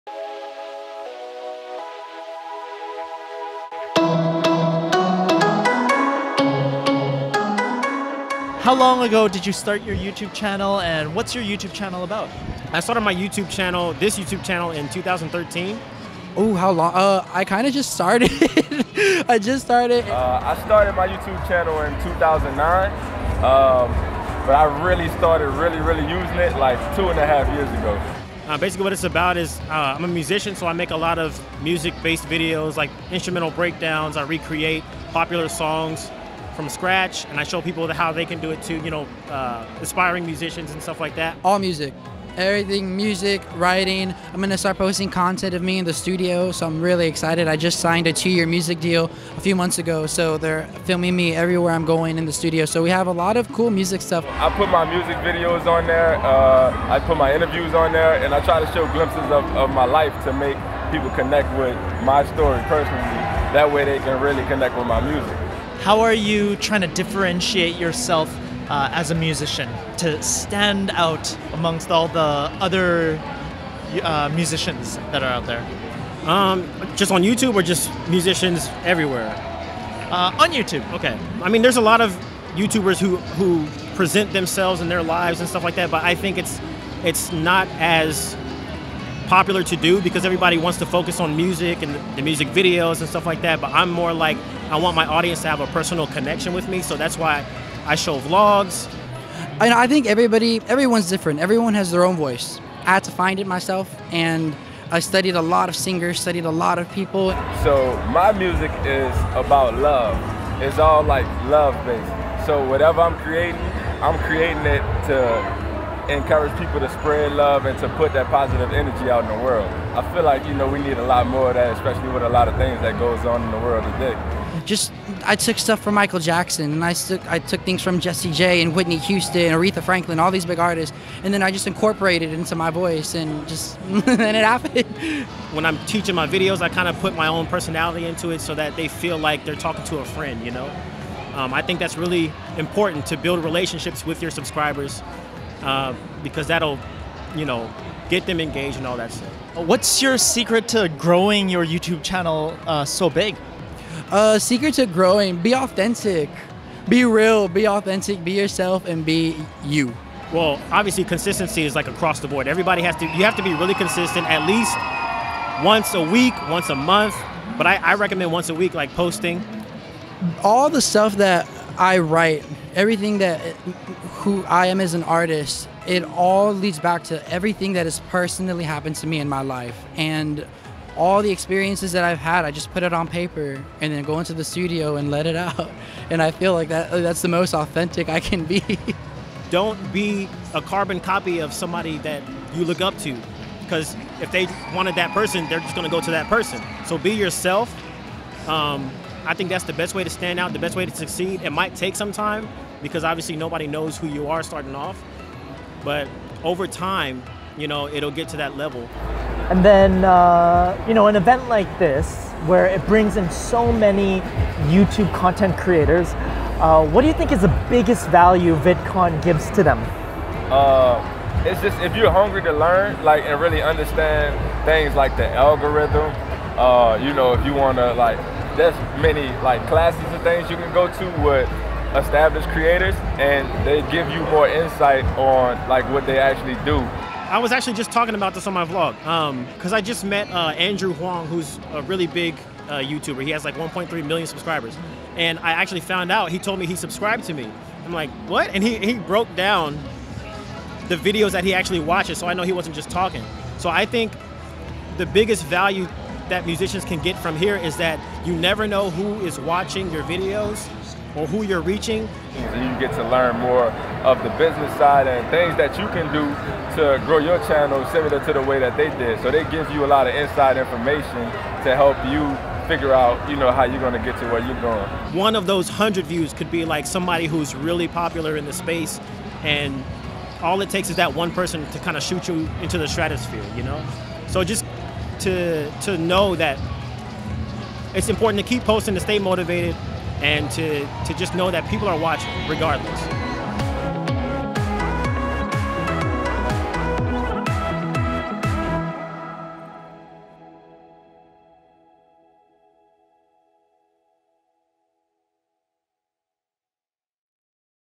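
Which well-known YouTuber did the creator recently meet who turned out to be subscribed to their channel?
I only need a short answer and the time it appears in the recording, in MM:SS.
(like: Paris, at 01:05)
Andrew Huang, at 04:00.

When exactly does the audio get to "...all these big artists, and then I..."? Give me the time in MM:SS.
02:10.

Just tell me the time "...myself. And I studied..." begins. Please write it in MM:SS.
01:43.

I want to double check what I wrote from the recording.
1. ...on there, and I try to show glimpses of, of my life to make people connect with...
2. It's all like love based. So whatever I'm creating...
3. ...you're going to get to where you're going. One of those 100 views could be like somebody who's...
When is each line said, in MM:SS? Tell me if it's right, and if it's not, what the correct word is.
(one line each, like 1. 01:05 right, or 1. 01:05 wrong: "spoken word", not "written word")
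1. 00:57 right
2. 01:50 right
3. 04:33 right.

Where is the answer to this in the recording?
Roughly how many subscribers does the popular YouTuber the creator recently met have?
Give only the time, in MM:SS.
04:03.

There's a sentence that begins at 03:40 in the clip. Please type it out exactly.
Uh, it's just if you're hungry to learn, like, and really understand things like the algorithm.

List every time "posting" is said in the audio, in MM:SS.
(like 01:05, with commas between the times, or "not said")
00:44, 02:48, 04:48.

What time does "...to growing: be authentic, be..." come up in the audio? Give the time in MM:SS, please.
02:34.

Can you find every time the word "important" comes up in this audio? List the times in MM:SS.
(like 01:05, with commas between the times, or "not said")
02:22, 04:48.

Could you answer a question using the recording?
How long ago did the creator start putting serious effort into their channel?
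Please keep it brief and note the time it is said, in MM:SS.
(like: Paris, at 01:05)
2.5 years ago, at 00:26.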